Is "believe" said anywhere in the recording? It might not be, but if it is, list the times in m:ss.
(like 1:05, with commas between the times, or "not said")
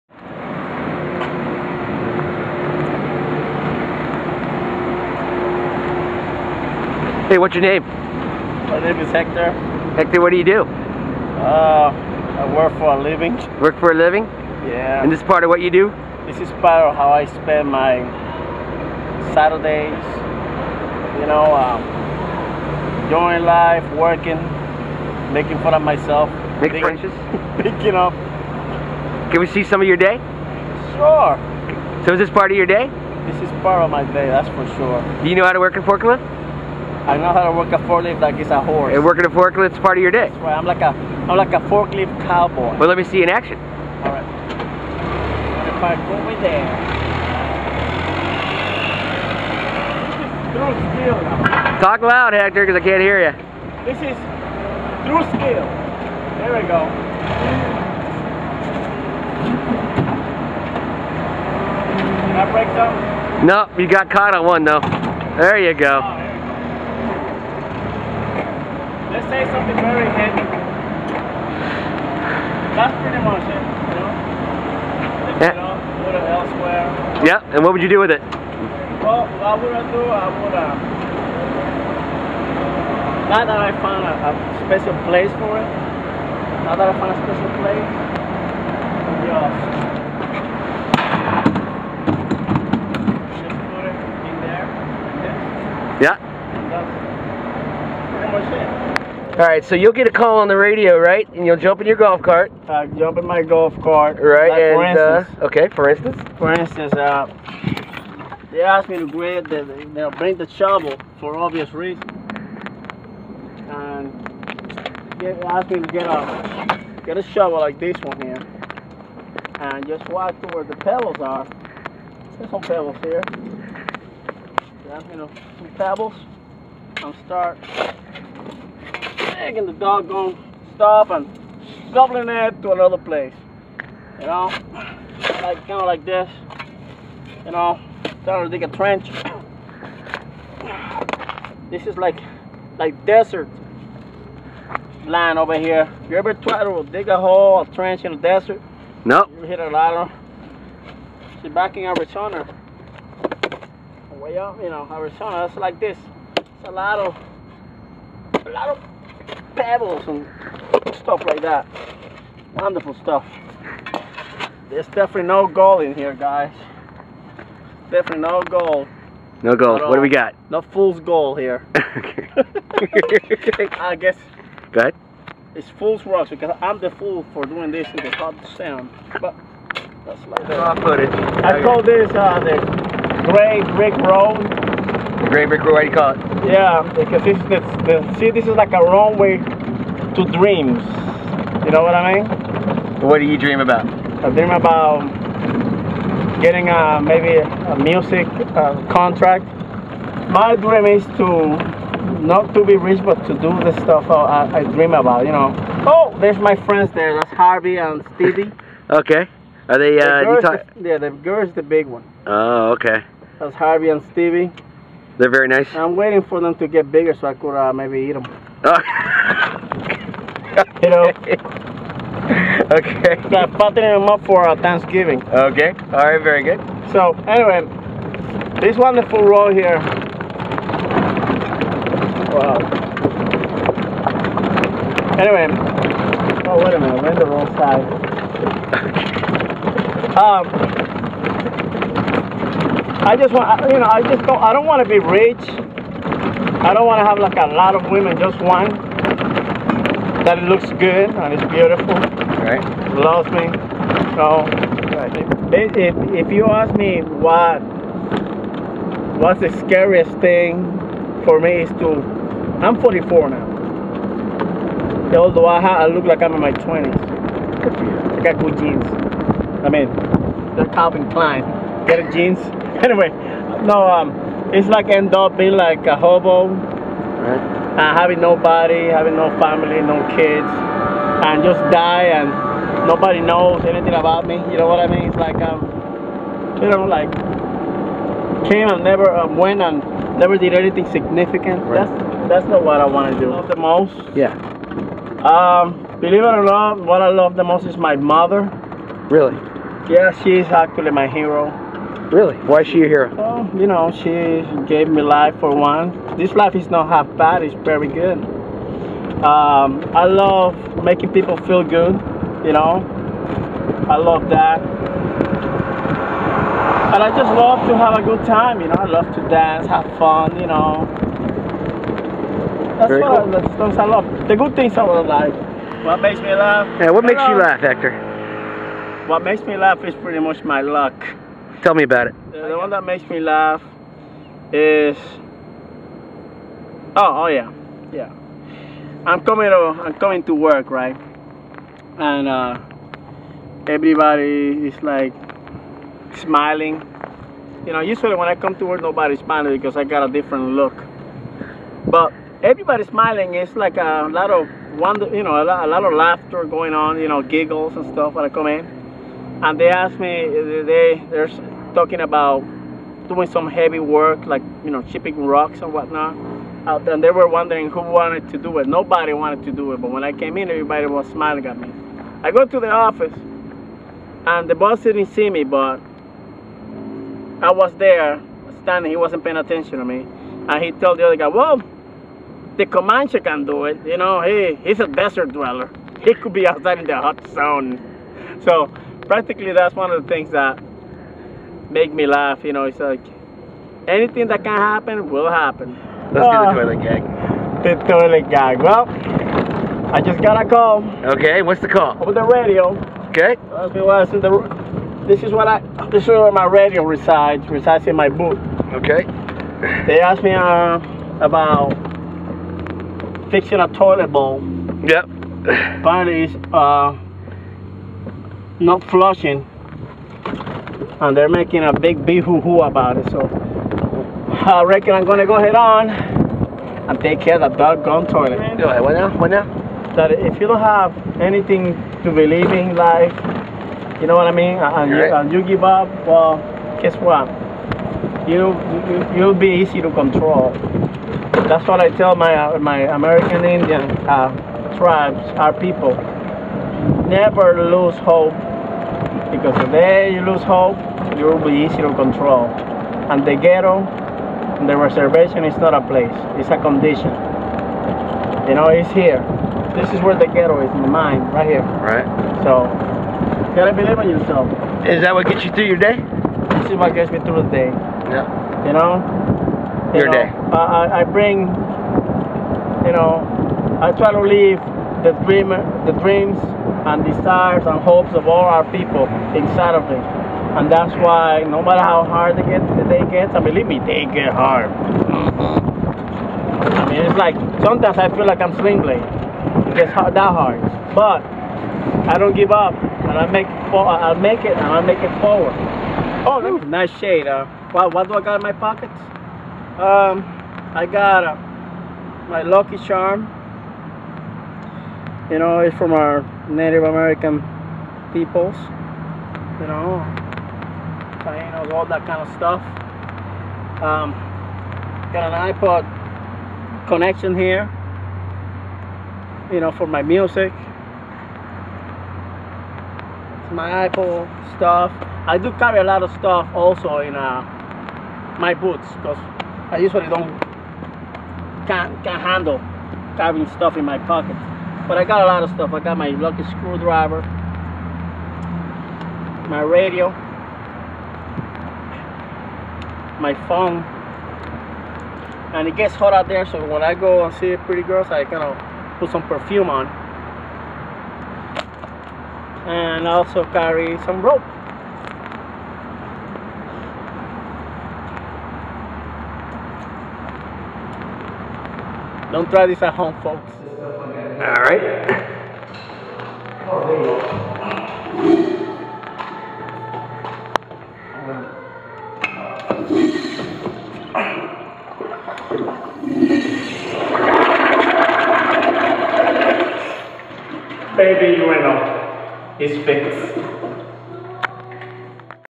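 4:56, 7:12, 7:43, 8:03.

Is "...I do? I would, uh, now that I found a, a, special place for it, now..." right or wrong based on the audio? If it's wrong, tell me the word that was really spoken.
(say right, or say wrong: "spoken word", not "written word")
right.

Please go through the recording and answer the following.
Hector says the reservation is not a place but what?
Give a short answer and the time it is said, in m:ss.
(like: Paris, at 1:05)
a condition, at 7:36.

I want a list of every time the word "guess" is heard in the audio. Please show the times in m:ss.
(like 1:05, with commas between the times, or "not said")
2:53, 7:16.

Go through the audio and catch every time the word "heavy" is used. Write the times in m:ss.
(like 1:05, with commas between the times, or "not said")
1:10, 6:03.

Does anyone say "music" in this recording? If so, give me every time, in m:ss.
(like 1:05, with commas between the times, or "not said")
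3:17, 8:40.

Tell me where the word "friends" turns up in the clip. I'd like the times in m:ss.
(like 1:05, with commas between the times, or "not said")
3:26.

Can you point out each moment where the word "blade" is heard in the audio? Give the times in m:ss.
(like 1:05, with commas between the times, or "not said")
8:08.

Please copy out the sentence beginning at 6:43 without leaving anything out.
Okay, well, the, this is what I.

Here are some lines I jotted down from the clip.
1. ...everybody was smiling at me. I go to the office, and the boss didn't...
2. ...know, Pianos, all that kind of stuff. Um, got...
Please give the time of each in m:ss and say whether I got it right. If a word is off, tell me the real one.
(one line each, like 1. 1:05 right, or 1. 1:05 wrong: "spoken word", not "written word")
1. 6:10 right
2. 8:29 right.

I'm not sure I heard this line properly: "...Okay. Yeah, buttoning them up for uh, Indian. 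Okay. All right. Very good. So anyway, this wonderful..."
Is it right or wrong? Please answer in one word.
wrong.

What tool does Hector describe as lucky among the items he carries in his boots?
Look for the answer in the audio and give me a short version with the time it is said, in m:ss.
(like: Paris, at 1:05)
screwdriver, at 8:56.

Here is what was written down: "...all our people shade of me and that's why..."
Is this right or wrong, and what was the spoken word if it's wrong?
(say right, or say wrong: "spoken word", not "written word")
wrong: "inside", not "shade".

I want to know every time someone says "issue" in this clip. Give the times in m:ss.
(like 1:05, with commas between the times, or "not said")
not said.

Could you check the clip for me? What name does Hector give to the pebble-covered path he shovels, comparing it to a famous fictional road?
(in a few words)
the gray brick road.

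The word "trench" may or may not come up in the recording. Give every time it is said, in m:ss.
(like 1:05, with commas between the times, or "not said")
2:18, 2:27.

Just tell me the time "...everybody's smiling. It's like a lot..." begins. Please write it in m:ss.
5:52.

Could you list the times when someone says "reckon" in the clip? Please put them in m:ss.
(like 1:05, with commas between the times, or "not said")
7:04.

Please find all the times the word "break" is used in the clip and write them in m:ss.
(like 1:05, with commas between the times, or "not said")
1:02.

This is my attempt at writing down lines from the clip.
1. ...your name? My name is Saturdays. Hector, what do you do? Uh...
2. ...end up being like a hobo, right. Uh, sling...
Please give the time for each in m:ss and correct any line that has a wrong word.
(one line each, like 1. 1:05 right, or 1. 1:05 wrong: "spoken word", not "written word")
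1. 0:07 wrong: "Hector", not "Saturdays"
2. 4:34 wrong: "having", not "sling".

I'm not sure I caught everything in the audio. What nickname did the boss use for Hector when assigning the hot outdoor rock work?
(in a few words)
the Comanche.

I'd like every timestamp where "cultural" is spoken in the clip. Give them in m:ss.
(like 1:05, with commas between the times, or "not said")
not said.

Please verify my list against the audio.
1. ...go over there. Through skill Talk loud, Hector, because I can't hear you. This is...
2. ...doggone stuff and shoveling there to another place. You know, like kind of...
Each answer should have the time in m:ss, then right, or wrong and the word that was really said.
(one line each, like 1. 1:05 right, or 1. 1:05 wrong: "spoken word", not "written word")
1. 0:45 right
2. 2:09 right.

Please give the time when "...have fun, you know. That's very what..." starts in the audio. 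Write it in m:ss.
5:19.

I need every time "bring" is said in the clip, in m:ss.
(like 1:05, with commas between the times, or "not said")
1:50, 7:51.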